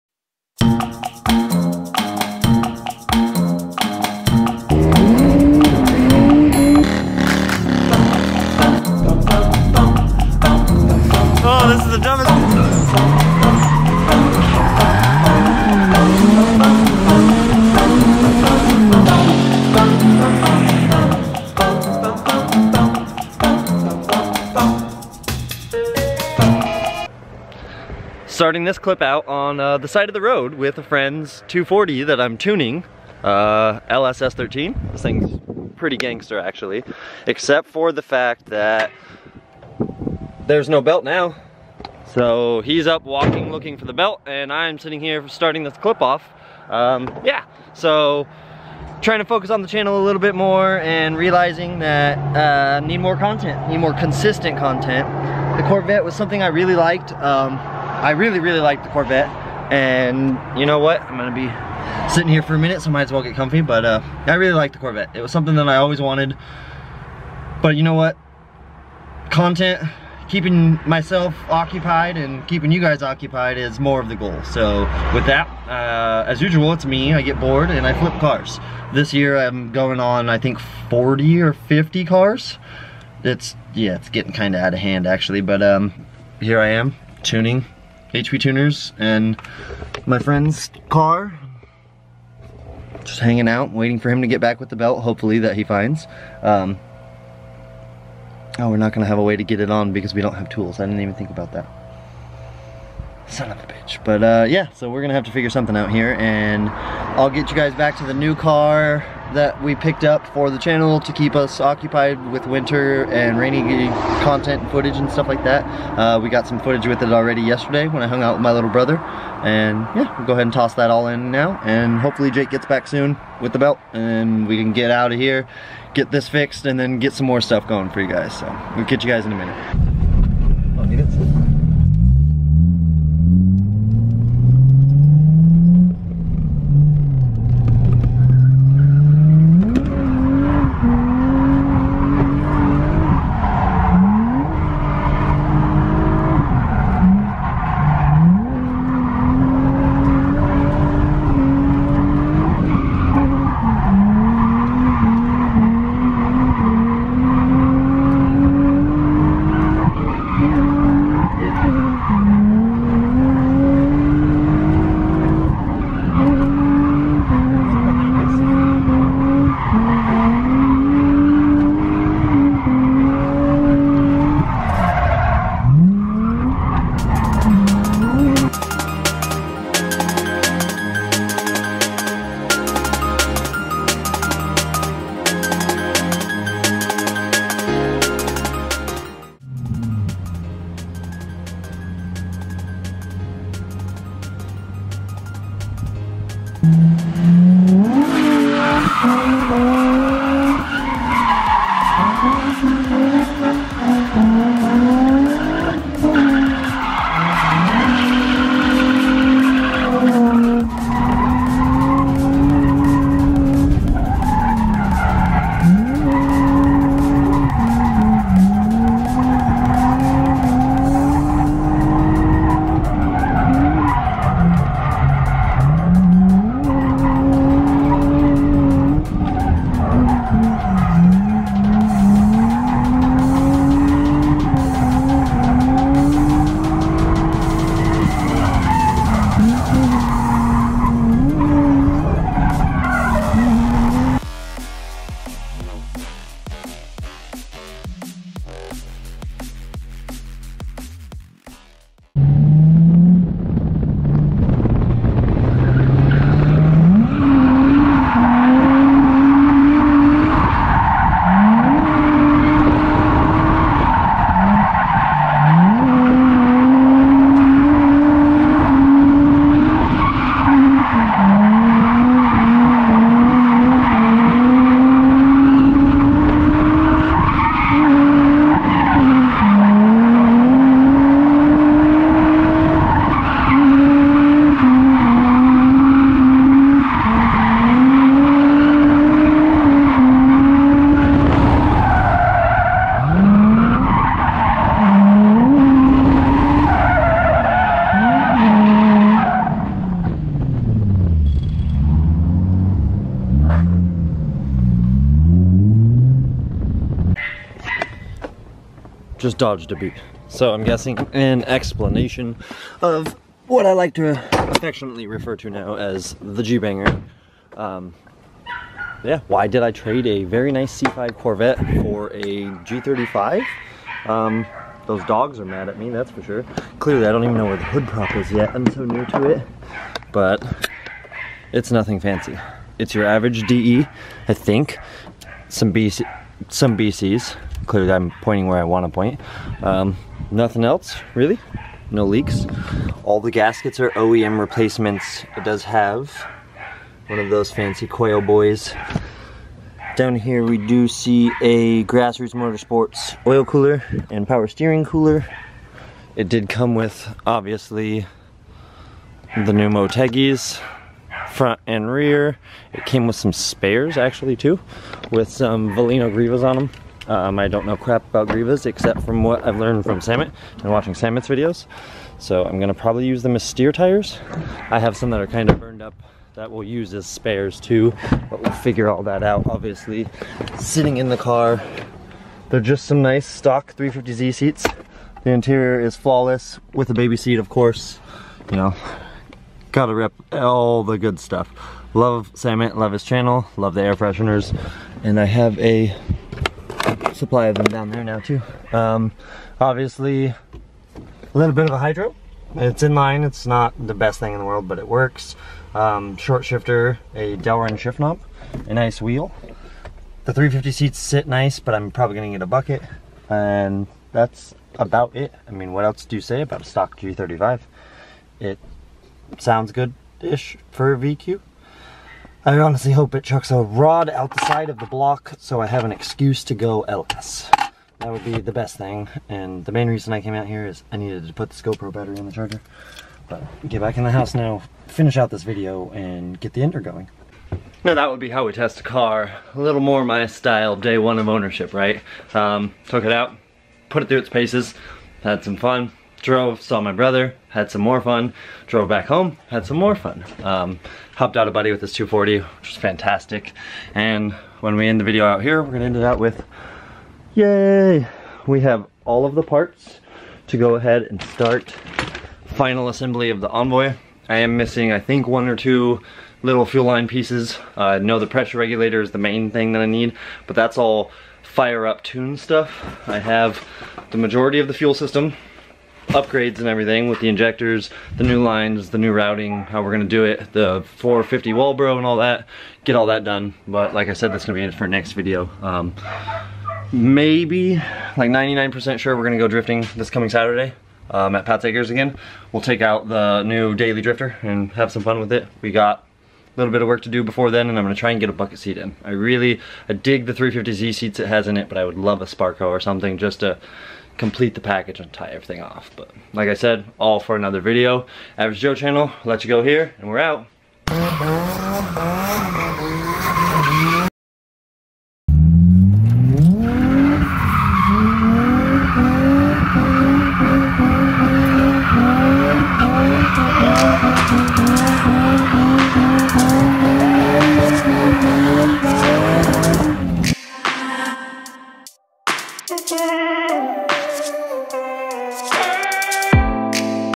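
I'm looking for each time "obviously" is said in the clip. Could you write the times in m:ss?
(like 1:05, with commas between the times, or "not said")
5:57, 6:19, 6:39.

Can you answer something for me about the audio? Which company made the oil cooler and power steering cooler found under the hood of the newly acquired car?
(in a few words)
Grassroots Motorsports.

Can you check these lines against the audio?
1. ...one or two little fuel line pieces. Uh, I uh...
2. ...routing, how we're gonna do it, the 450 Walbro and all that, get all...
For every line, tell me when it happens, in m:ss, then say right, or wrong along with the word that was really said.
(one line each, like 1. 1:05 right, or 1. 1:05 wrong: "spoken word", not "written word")
1. 7:45 right
2. 7:59 right.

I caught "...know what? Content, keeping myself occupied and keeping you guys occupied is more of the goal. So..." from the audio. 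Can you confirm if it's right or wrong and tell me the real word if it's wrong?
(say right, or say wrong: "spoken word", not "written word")
right.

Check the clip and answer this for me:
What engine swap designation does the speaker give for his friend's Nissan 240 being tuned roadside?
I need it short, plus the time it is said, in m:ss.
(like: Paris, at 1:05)
LS S13, at 0:33.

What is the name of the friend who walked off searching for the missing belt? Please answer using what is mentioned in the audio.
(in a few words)
Jake.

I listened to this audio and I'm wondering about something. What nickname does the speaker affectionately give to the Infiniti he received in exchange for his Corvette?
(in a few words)
G-Banger.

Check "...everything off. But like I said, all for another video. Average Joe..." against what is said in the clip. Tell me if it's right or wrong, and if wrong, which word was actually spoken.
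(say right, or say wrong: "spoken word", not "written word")
right.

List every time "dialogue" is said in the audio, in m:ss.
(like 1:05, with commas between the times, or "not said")
not said.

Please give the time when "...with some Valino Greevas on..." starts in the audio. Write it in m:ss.
6:05.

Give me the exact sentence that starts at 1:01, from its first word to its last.
I'm gonna be sitting here for a minute, so might as well get comfy.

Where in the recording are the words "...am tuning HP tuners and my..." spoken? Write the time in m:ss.
1:26.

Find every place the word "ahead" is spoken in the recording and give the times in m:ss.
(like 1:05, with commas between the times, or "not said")
2:00, 7:40.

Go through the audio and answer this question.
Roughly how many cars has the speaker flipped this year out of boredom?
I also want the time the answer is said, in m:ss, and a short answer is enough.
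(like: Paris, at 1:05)
40 or 50, at 1:20.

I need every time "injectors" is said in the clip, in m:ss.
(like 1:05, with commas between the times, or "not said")
7:57.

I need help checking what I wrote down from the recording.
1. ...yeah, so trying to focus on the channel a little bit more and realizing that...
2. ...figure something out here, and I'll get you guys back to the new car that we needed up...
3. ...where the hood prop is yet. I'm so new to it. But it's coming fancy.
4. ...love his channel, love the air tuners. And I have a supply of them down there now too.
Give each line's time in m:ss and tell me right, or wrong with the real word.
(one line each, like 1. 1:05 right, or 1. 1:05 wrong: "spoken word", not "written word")
1. 0:47 right
2. 1:45 wrong: "picked", not "needed"
3. 5:27 wrong: "nothing", not "coming"
4. 6:32 wrong: "fresheners", not "tuners".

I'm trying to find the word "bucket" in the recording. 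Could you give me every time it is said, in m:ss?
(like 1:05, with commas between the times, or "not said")
6:52, 8:18.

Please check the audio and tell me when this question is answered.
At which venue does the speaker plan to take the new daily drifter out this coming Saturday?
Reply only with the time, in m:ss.
8:11.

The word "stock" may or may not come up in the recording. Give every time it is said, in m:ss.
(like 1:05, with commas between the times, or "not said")
6:23, 6:56.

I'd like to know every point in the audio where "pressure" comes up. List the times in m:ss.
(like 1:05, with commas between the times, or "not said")
7:48.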